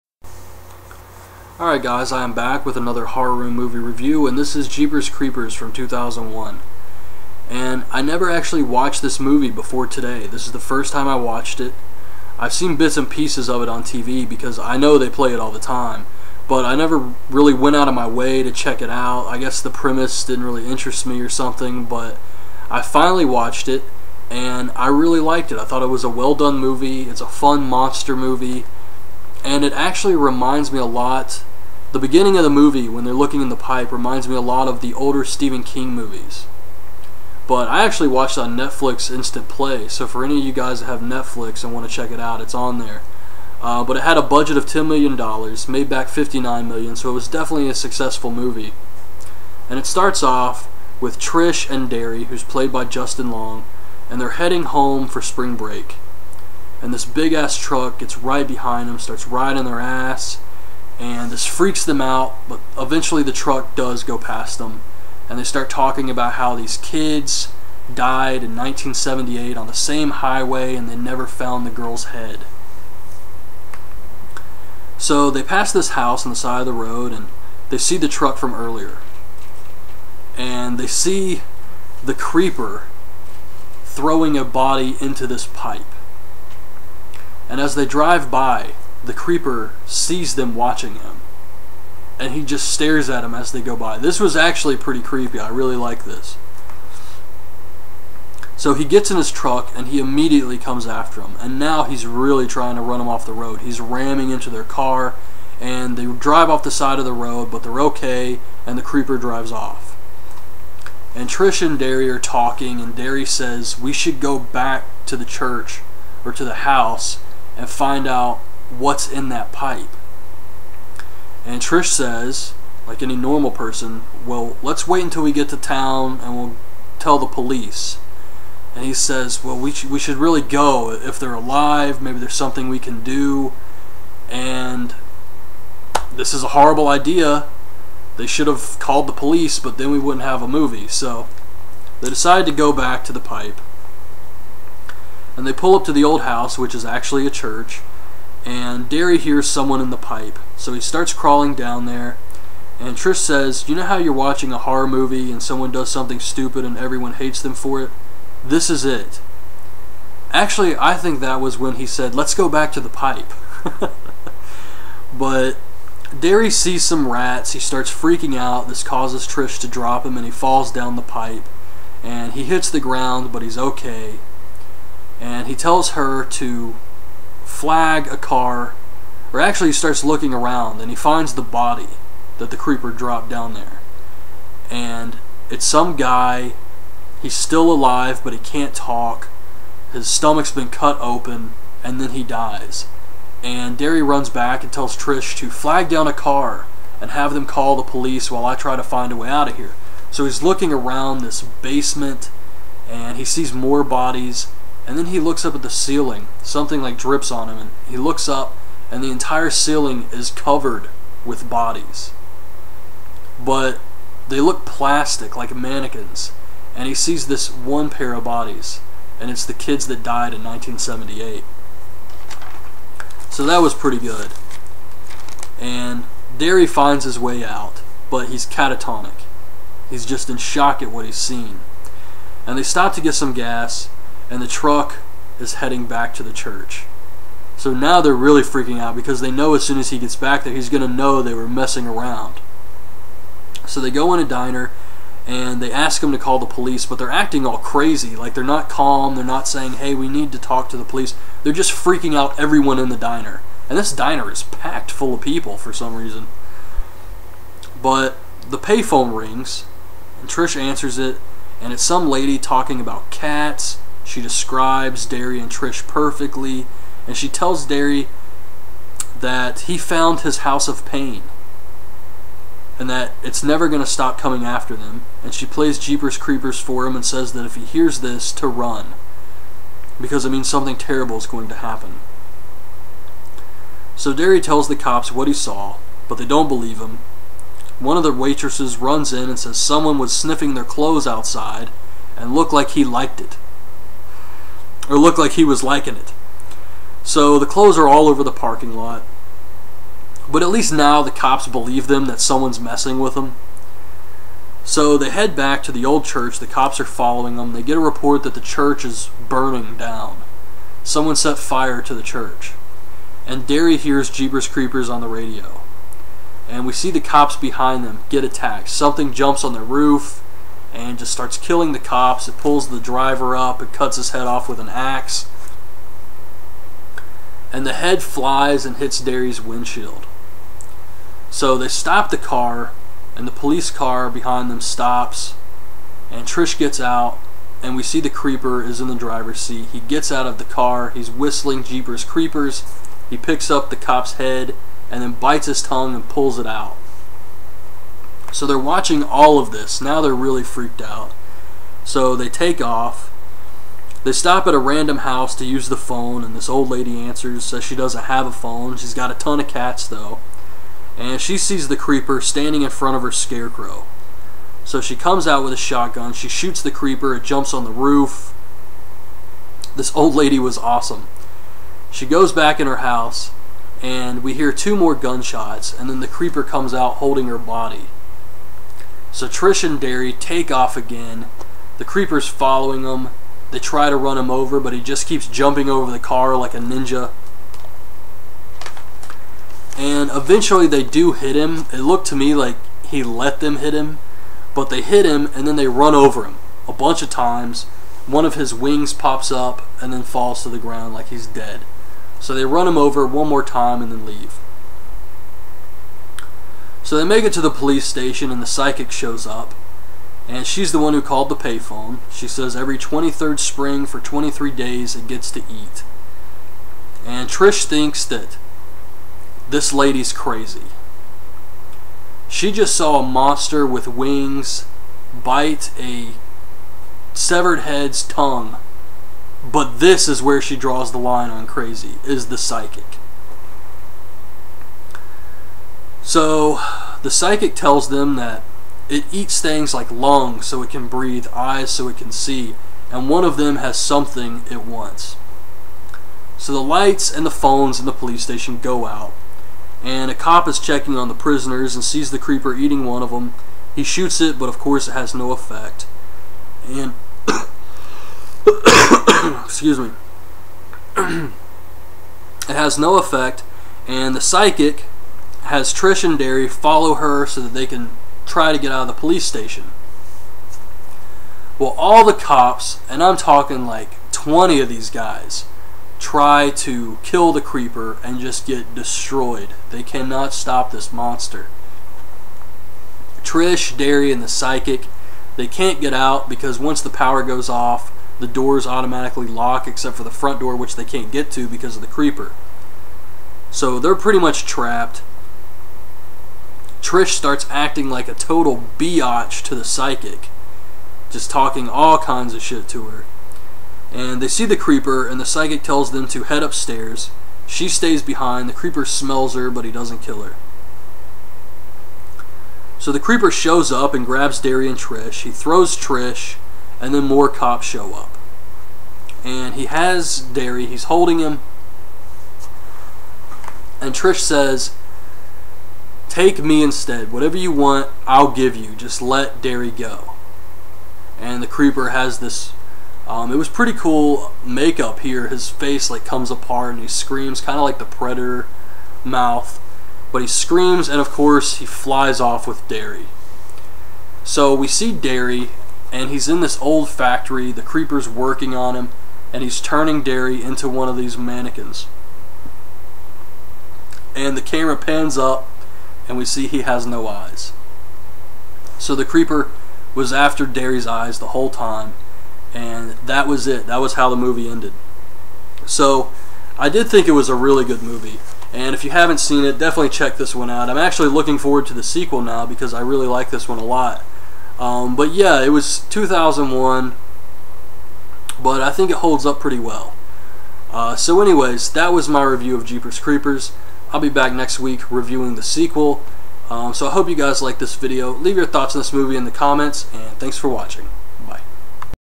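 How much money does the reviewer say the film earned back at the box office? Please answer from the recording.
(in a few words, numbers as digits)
$59 million.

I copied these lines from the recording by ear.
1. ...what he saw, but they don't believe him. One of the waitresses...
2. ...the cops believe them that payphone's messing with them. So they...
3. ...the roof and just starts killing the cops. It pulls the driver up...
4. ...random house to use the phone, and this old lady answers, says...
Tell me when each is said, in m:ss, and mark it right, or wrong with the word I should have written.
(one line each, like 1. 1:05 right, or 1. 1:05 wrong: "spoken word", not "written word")
1. 4:45 right
2. 5:01 wrong: "someone", not "payphone"
3. 5:19 right
4. 5:54 right.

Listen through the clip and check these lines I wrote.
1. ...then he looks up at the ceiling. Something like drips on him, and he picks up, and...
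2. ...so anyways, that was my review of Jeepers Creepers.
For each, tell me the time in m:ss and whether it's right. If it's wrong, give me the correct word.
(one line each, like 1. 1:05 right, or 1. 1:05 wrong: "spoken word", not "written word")
1. 3:24 wrong: "looks", not "picks"
2. 9:40 right.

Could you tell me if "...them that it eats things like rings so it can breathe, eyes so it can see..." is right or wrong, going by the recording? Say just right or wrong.
wrong.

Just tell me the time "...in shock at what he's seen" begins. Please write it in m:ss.
3:50.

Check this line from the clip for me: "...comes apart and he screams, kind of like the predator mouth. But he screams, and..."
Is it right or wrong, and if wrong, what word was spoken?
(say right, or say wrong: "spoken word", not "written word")
right.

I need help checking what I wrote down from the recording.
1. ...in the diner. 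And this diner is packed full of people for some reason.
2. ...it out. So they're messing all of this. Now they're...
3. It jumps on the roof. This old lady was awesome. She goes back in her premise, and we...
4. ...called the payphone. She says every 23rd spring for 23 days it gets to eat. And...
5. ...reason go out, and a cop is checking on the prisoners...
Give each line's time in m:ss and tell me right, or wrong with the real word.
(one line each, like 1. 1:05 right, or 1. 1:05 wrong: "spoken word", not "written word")
1. 4:12 right
2. 5:46 wrong: "watching", not "messing"
3. 6:07 wrong: "house", not "premise"
4. 6:51 right
5. 7:28 wrong: "station", not "reason".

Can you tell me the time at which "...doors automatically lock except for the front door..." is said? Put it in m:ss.
8:08.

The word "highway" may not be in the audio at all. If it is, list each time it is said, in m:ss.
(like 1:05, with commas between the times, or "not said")
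1:10.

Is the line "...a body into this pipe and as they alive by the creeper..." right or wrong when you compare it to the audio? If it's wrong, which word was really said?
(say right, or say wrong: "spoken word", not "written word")
wrong: "drive", not "alive".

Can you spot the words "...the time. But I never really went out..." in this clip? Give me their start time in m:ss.
0:15.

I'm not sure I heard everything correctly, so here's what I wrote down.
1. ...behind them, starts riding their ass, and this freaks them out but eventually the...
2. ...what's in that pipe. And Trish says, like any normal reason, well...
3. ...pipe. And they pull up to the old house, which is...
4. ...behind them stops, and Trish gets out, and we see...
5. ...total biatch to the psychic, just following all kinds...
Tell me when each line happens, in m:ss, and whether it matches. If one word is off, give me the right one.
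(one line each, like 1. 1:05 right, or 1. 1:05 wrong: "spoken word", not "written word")
1. 0:58 right
2. 1:58 wrong: "person", not "reason"
3. 2:23 right
4. 5:34 right
5. 8:18 wrong: "talking", not "following".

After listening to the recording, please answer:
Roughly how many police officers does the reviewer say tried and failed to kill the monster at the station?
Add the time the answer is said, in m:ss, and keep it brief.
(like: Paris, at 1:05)
20, at 7:54.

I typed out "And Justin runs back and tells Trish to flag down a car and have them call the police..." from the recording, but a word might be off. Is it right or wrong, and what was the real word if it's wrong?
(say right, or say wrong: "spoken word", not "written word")
wrong: "Darry", not "Justin".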